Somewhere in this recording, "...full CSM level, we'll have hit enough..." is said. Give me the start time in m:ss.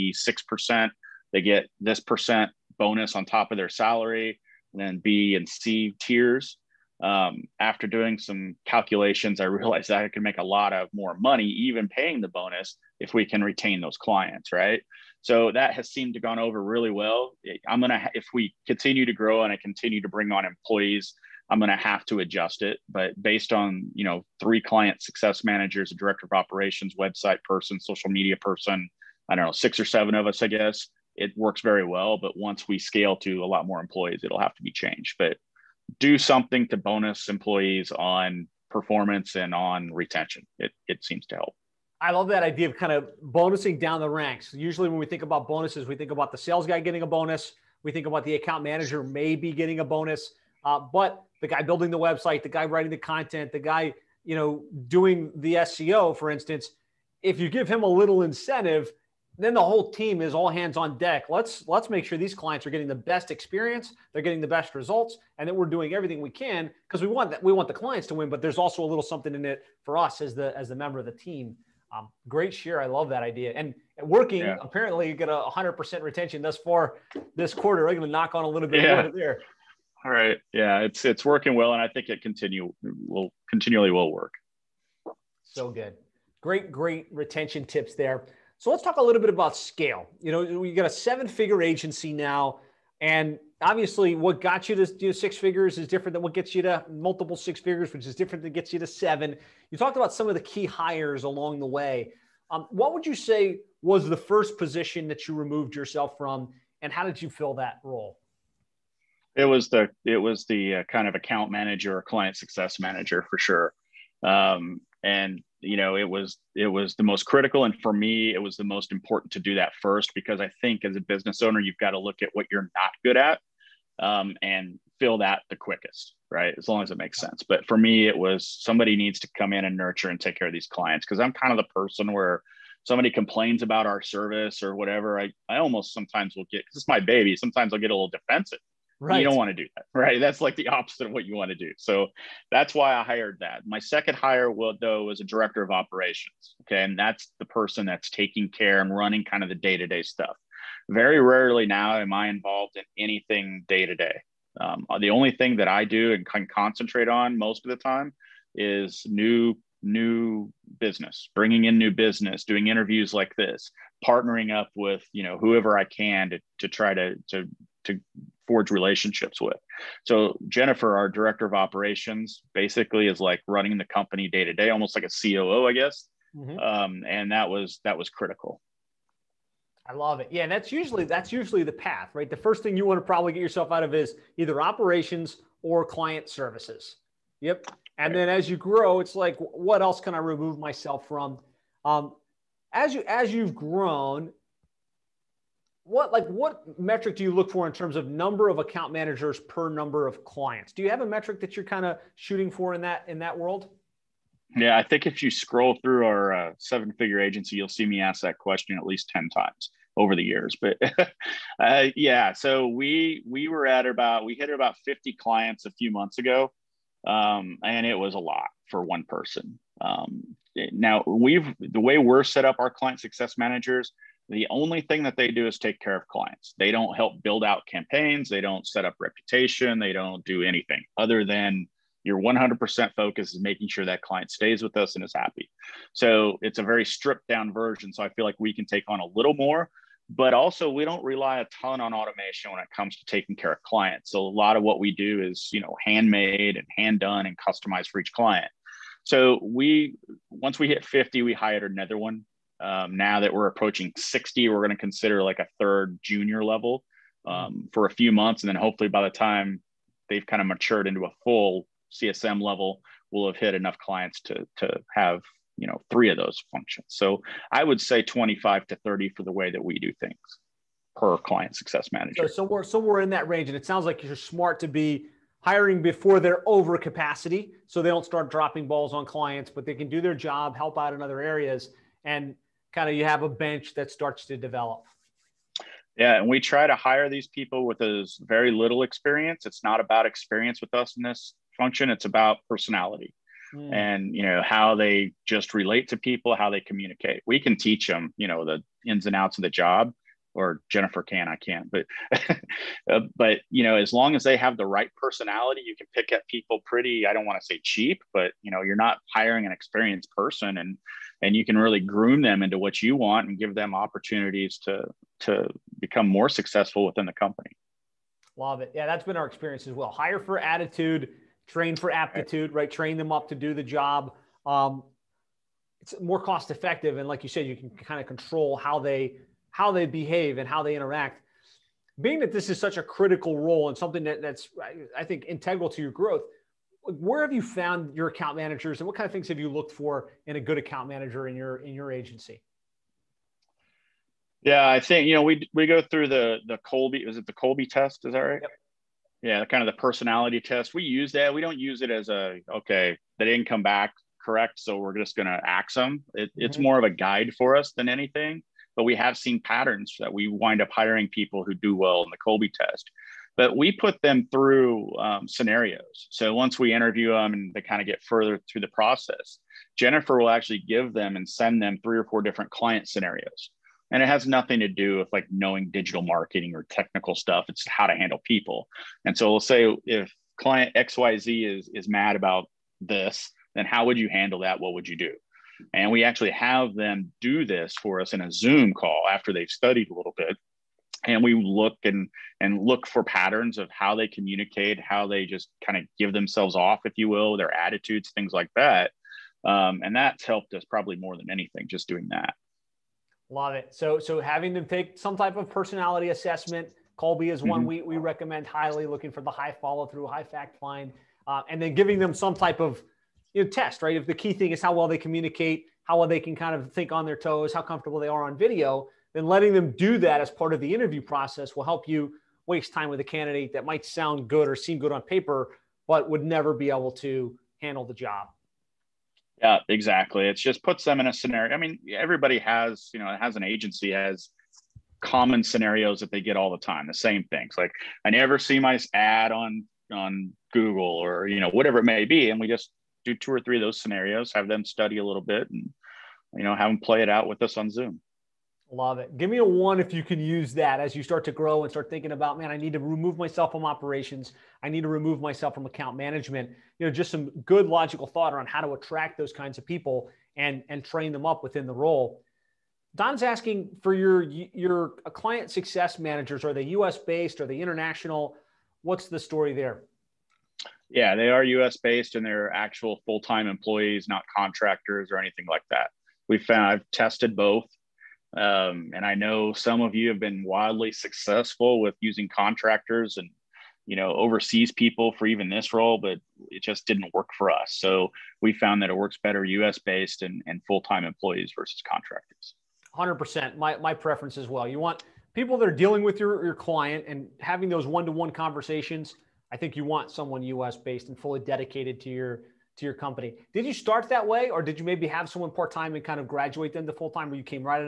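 4:21.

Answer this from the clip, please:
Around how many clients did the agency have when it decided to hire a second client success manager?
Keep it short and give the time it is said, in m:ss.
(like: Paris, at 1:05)
50, at 3:34.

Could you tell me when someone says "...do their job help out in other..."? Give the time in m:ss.
4:39.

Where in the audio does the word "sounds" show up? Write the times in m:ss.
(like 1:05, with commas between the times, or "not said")
4:33, 7:03.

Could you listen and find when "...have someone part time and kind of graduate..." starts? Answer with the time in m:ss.
8:25.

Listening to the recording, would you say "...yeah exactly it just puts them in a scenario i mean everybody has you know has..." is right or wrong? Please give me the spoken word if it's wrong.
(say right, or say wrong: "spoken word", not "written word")
right.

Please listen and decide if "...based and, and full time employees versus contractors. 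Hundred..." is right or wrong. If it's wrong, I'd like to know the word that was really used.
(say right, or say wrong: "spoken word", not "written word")
right.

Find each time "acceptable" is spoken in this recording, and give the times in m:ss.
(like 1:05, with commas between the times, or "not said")
not said.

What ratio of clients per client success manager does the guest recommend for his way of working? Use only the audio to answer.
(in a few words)
25 to 30.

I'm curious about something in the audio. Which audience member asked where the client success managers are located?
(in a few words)
Don.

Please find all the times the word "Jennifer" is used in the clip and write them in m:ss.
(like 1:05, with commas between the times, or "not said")
2:50, 5:00, 6:09.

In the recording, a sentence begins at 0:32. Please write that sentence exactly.
But once we scale to a lot more employees, it'll have to be changed.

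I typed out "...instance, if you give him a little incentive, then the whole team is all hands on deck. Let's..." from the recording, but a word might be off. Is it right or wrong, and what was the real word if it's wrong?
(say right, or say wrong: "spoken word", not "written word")
right.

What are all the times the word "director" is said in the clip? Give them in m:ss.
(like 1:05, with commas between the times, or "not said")
0:25, 2:25, 2:51.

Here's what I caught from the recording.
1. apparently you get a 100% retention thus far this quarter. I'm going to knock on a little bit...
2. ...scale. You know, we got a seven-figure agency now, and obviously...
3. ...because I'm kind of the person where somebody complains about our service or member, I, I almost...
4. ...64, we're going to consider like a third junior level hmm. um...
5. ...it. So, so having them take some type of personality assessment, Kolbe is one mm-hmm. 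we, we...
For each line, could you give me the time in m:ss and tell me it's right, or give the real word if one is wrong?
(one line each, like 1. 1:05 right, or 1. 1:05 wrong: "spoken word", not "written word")
1. 1:14 right
2. 1:29 right
3. 2:11 wrong: "whatever", not "member"
4. 4:13 wrong: "60", not "64"
5. 6:43 right.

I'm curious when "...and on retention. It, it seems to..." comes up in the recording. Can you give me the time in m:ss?
0:39.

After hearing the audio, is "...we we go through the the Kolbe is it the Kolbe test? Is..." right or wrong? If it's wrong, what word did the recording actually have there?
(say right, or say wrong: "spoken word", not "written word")
right.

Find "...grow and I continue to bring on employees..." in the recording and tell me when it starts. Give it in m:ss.
0:19.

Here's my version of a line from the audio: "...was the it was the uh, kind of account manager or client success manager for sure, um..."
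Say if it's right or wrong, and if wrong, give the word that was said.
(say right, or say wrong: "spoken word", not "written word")
right.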